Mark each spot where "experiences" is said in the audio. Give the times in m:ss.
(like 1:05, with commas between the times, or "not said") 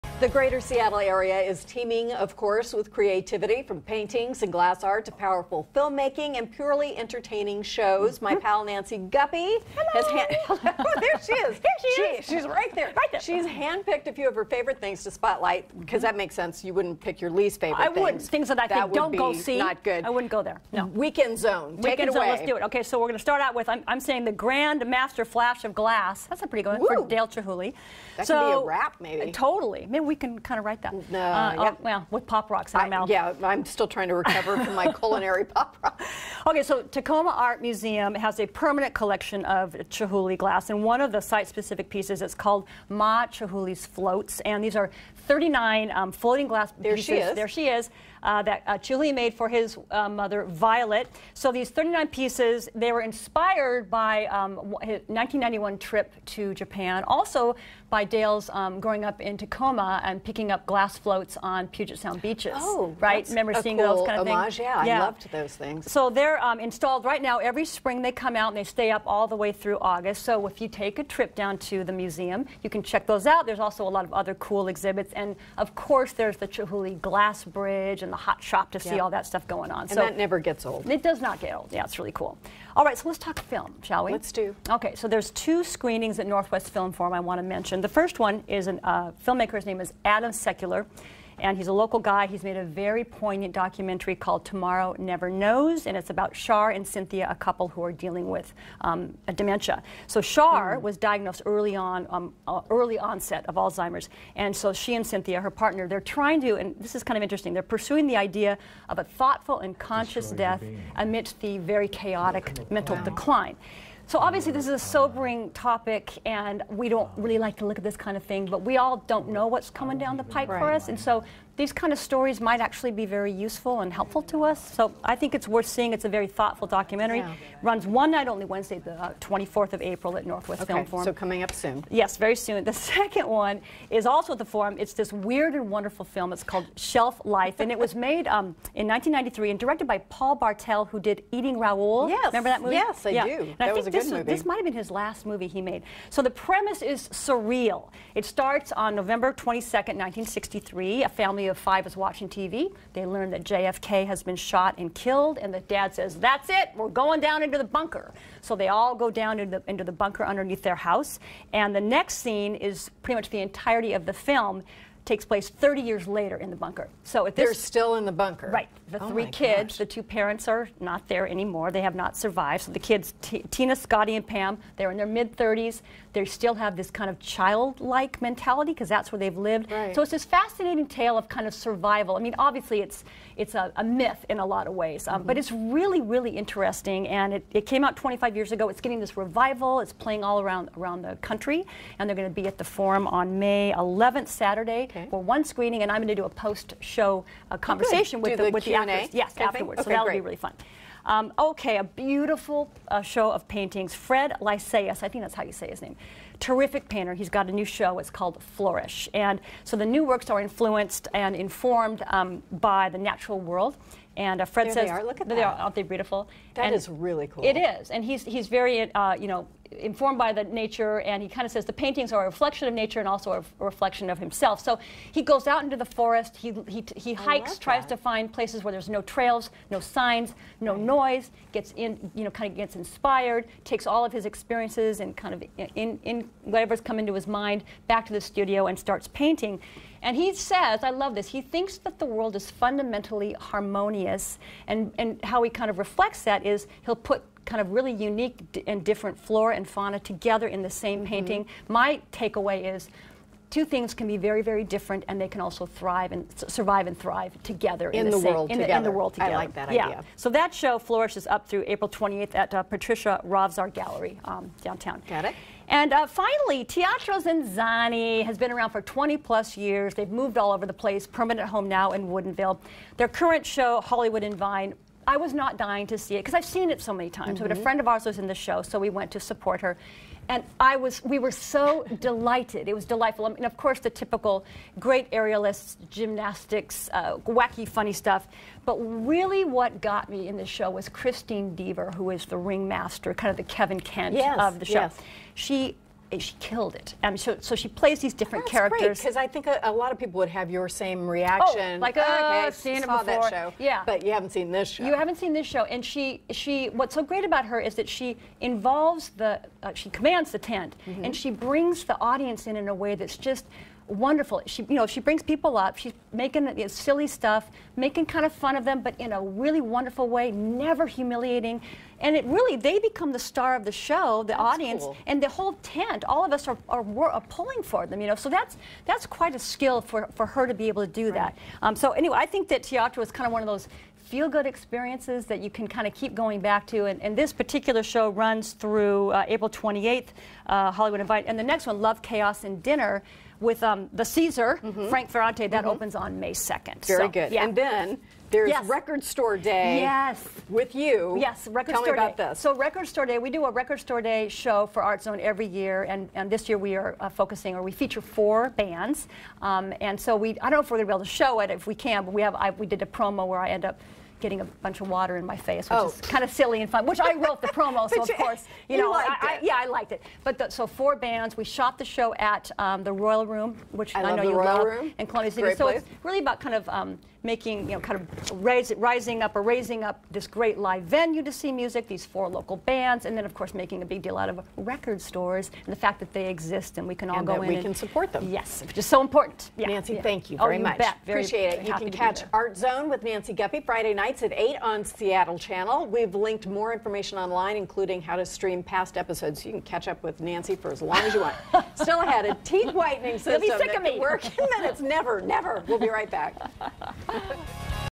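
3:54, 5:34.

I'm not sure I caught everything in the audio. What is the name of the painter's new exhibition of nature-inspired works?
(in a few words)
Flourish.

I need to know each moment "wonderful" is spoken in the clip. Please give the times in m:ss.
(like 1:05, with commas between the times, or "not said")
2:15, 5:13, 5:19.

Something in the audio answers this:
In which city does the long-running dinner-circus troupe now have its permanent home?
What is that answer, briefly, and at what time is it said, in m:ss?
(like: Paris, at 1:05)
Woodinville, at 4:32.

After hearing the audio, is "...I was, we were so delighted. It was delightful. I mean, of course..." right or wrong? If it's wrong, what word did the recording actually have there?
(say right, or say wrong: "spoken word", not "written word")
right.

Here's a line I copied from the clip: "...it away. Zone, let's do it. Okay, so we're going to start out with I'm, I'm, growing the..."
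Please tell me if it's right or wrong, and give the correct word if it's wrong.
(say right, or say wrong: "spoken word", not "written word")
wrong: "saying", not "growing".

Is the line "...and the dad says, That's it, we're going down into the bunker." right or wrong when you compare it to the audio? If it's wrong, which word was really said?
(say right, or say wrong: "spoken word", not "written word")
right.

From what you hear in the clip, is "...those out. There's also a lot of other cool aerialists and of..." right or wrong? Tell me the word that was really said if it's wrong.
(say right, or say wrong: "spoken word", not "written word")
wrong: "exhibits", not "aerialists".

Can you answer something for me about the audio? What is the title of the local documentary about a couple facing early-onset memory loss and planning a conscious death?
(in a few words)
Tomorrow Never Knows.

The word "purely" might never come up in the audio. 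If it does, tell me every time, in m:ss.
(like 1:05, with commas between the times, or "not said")
0:06.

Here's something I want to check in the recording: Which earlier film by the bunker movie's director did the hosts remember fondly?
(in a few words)
Eating Raoul.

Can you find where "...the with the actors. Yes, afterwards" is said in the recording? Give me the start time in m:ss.
3:18.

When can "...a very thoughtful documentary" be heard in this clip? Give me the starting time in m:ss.
2:06.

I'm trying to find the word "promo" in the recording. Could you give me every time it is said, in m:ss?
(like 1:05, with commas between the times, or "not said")
6:02, 6:07.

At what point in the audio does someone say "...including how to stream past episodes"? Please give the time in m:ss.
6:37.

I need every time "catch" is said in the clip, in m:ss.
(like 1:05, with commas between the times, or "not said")
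6:31, 6:39.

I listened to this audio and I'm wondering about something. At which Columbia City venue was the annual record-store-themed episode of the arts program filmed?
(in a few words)
the Royal Room.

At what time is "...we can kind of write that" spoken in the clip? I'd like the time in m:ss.
0:30.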